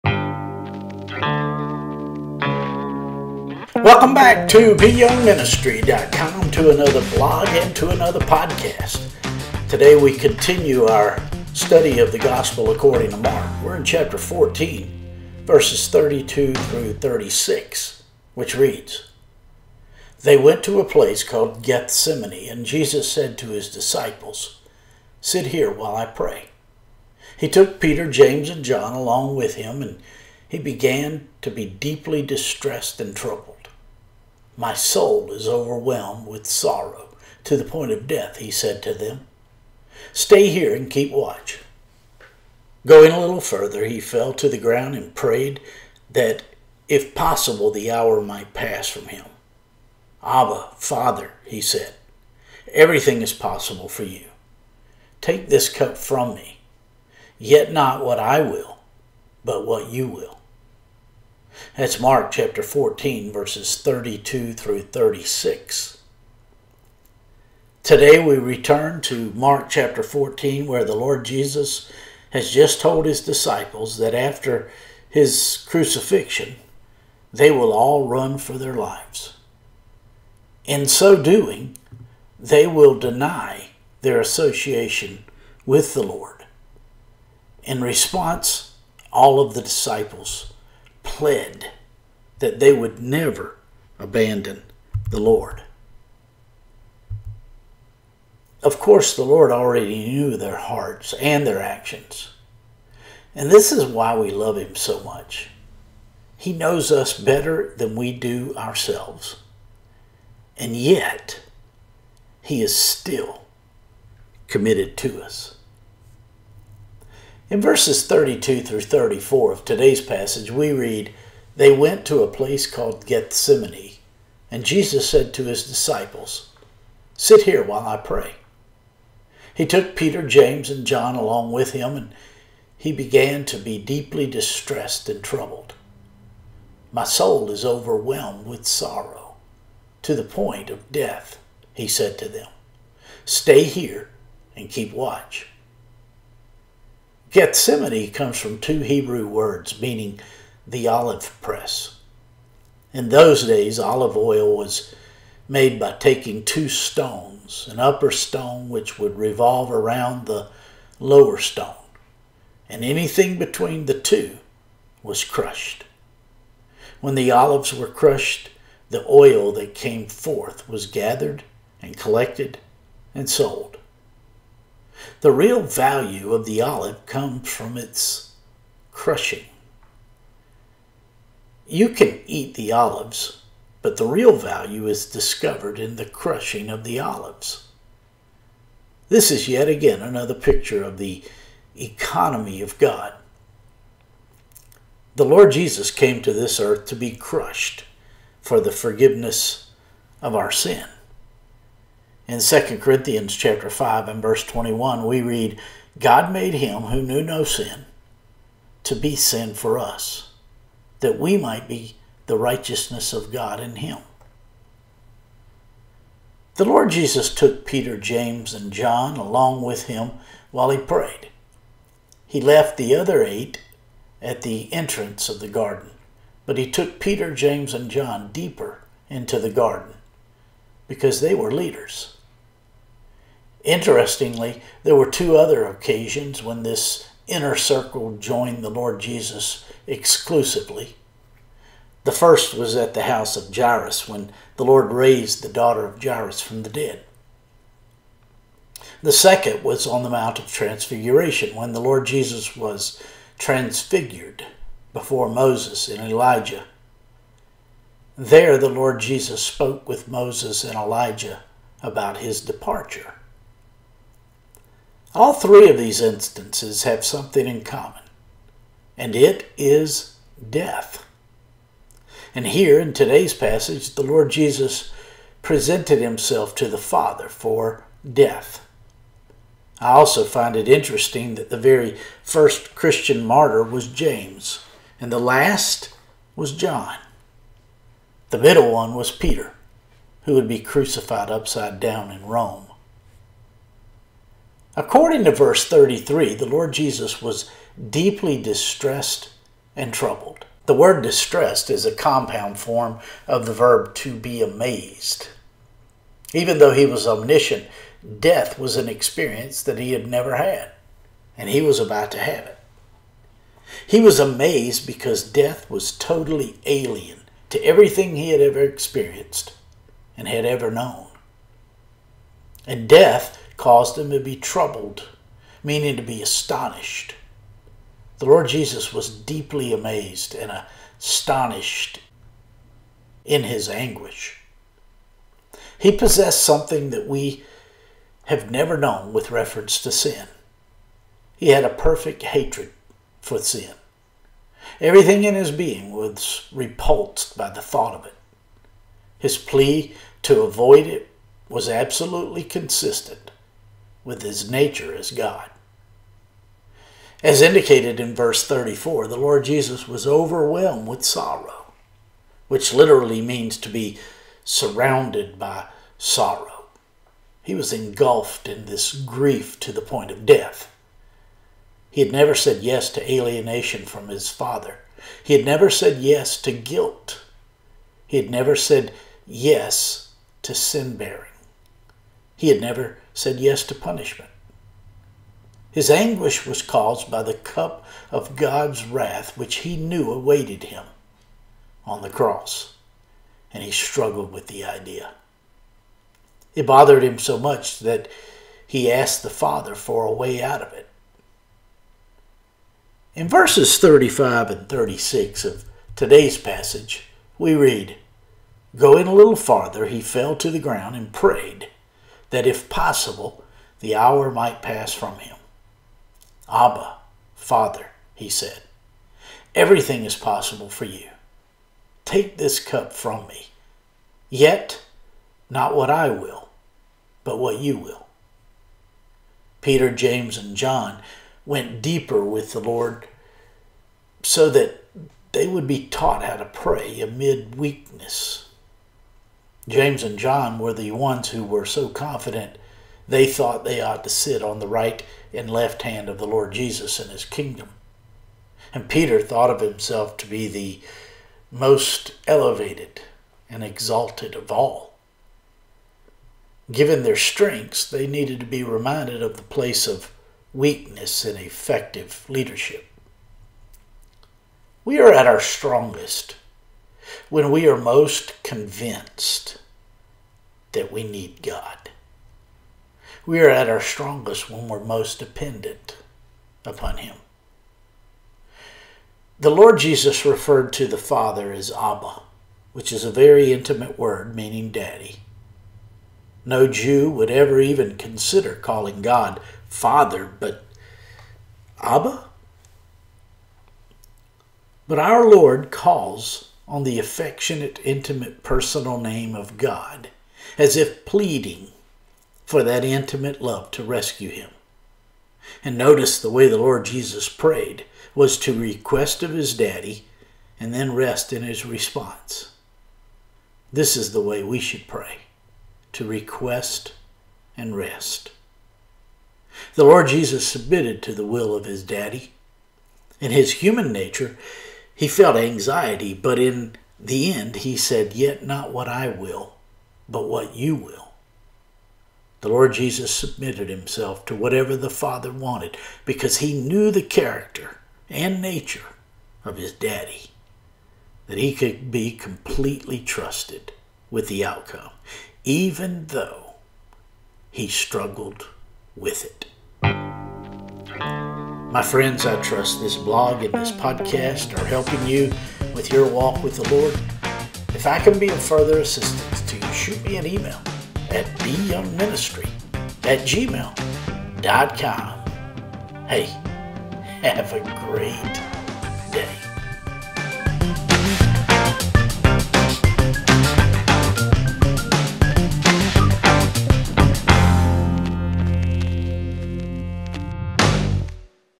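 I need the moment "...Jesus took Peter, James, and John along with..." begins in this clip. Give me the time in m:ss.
3:36.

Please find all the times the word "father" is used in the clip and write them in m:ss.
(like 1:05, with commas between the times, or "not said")
0:50, 4:36, 6:14, 6:39, 6:57, 8:00, 8:09, 8:54.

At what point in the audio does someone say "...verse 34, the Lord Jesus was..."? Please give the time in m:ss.
5:58.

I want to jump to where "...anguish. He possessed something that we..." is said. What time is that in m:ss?
5:33.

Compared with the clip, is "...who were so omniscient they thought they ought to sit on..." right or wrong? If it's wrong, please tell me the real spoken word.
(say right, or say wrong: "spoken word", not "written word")
wrong: "confident", not "omniscient".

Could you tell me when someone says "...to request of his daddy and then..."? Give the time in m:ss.
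8:28.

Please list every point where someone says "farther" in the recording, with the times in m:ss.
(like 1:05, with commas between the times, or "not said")
6:49.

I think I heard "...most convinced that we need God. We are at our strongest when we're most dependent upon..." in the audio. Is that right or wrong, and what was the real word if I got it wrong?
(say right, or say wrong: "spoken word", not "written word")
right.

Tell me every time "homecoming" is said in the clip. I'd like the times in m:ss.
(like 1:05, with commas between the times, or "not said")
not said.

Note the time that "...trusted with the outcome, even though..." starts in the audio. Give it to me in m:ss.
9:02.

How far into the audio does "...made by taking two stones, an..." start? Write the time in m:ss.
2:35.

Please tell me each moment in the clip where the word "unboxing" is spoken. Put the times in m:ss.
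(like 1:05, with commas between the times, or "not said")
not said.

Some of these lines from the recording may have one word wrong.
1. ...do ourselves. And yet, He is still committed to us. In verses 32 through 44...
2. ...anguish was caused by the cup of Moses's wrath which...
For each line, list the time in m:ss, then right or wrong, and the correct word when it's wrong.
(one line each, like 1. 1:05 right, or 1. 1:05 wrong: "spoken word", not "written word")
1. 1:48 wrong: "34", not "44"
2. 6:25 wrong: "God", not "Moses".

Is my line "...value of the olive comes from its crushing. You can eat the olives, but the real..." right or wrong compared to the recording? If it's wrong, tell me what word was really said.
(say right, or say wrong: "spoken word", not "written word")
right.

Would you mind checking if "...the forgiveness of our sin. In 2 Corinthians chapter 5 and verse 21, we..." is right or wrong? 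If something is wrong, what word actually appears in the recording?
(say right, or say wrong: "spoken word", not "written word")
right.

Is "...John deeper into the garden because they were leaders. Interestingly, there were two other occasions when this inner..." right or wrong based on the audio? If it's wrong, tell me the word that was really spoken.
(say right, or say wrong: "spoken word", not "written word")
right.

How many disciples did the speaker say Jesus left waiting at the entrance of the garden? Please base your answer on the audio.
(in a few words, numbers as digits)
8.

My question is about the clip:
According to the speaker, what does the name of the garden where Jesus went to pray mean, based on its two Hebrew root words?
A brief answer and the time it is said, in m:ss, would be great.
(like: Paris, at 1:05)
the olive press, at 2:30.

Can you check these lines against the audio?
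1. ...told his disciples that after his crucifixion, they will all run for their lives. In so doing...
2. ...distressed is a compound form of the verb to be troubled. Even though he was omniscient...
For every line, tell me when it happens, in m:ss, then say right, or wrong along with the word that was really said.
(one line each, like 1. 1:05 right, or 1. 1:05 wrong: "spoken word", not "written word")
1. 1:12 right
2. 5:01 wrong: "amazed", not "troubled".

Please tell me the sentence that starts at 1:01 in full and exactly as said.
That's Mark chapter 14, verses 32 through 36.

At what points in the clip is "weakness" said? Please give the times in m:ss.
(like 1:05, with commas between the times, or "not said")
7:17, 7:40.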